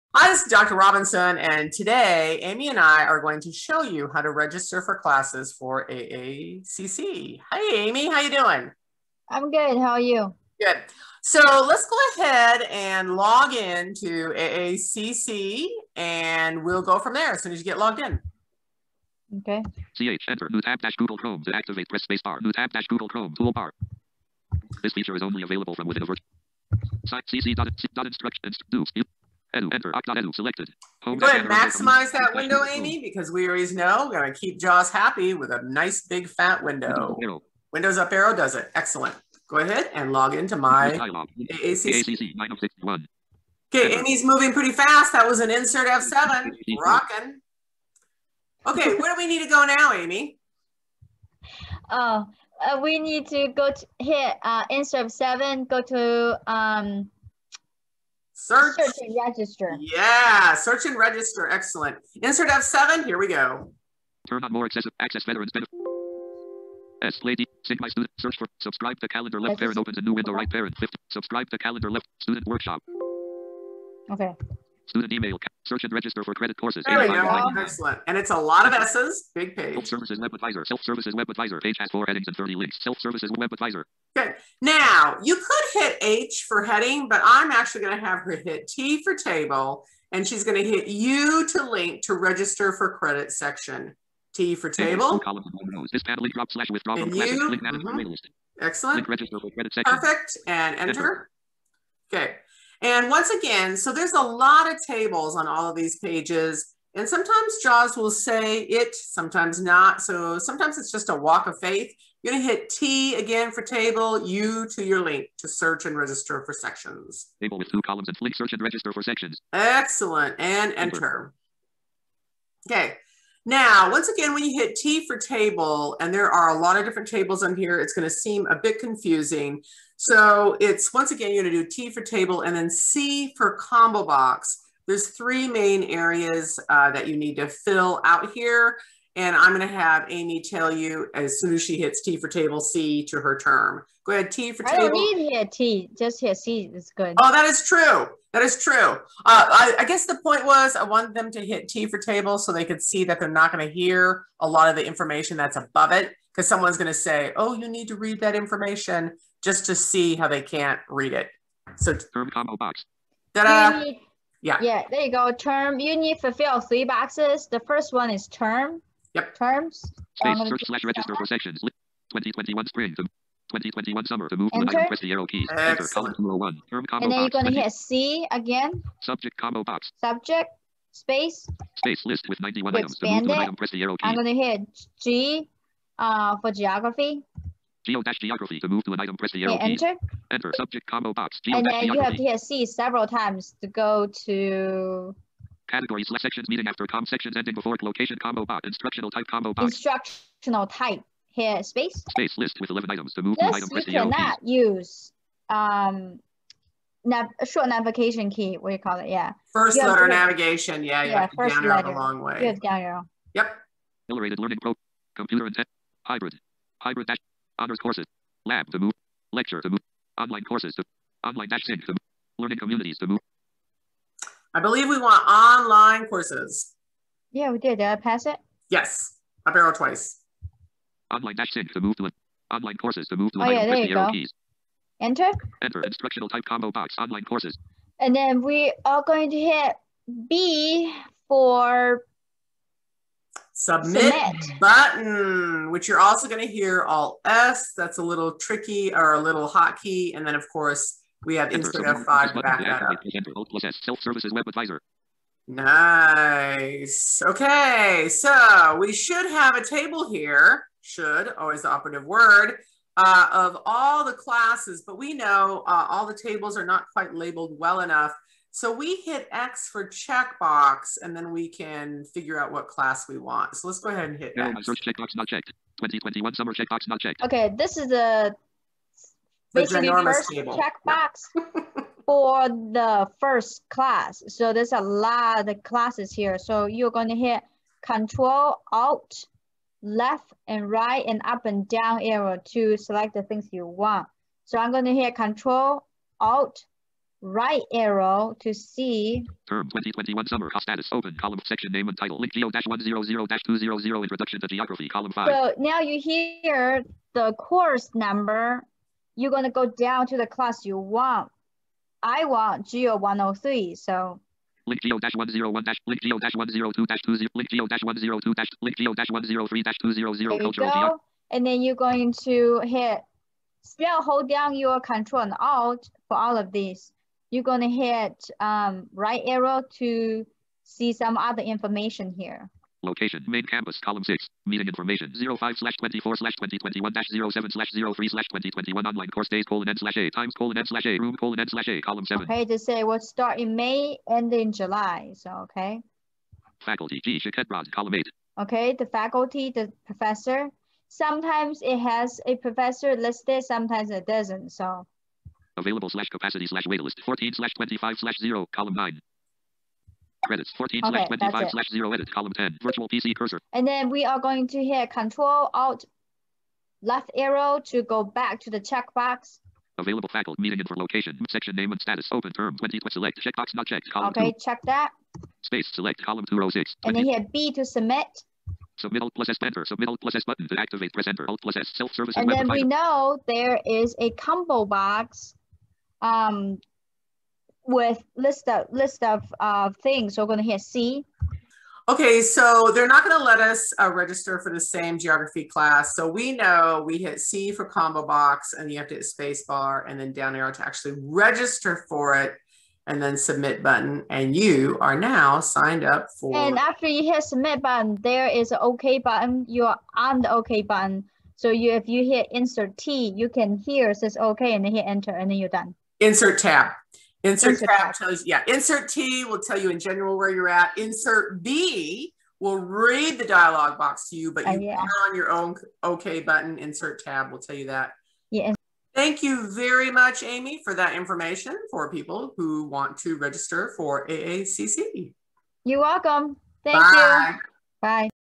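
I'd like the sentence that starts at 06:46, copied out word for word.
And after you hit submit button, there is an OK button.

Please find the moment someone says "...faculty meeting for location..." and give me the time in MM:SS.
06:10.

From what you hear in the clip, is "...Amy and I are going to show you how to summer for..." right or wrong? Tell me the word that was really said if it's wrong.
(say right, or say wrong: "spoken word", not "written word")
wrong: "register", not "summer".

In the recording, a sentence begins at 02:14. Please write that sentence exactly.
There's three main areas uh, that you need to fill out here.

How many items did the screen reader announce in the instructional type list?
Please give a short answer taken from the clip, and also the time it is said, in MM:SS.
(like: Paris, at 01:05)
11, at 03:22.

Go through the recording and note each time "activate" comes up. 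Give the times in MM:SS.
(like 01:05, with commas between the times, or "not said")
00:21, 06:20.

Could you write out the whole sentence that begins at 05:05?
So now you hear the course number.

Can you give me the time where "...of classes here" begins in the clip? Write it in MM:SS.
04:45.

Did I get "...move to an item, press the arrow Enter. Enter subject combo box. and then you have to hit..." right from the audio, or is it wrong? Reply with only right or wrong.
right.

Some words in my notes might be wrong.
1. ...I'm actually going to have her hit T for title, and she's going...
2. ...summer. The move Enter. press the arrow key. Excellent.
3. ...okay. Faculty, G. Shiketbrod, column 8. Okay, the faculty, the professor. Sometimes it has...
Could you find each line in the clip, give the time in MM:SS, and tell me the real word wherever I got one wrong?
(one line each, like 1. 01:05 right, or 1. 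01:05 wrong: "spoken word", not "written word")
1. 01:27 wrong: "table", not "title"
2. 02:54 right
3. 05:45 right.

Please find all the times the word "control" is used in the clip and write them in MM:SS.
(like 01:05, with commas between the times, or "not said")
04:47, 04:55, 05:24, 06:04.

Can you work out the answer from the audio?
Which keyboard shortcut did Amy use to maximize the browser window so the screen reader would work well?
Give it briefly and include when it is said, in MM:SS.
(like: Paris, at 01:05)
Windows up arrow, at 00:37.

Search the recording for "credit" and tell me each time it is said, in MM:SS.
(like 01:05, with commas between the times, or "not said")
01:16, 01:32, 06:00.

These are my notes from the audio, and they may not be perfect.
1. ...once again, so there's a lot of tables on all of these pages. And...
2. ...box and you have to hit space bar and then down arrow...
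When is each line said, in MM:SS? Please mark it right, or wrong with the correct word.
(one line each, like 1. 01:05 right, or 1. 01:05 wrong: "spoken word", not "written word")
1. 01:43 right
2. 06:38 right.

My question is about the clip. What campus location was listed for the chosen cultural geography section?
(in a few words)
Main campus.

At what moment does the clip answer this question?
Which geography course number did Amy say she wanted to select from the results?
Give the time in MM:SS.
05:12.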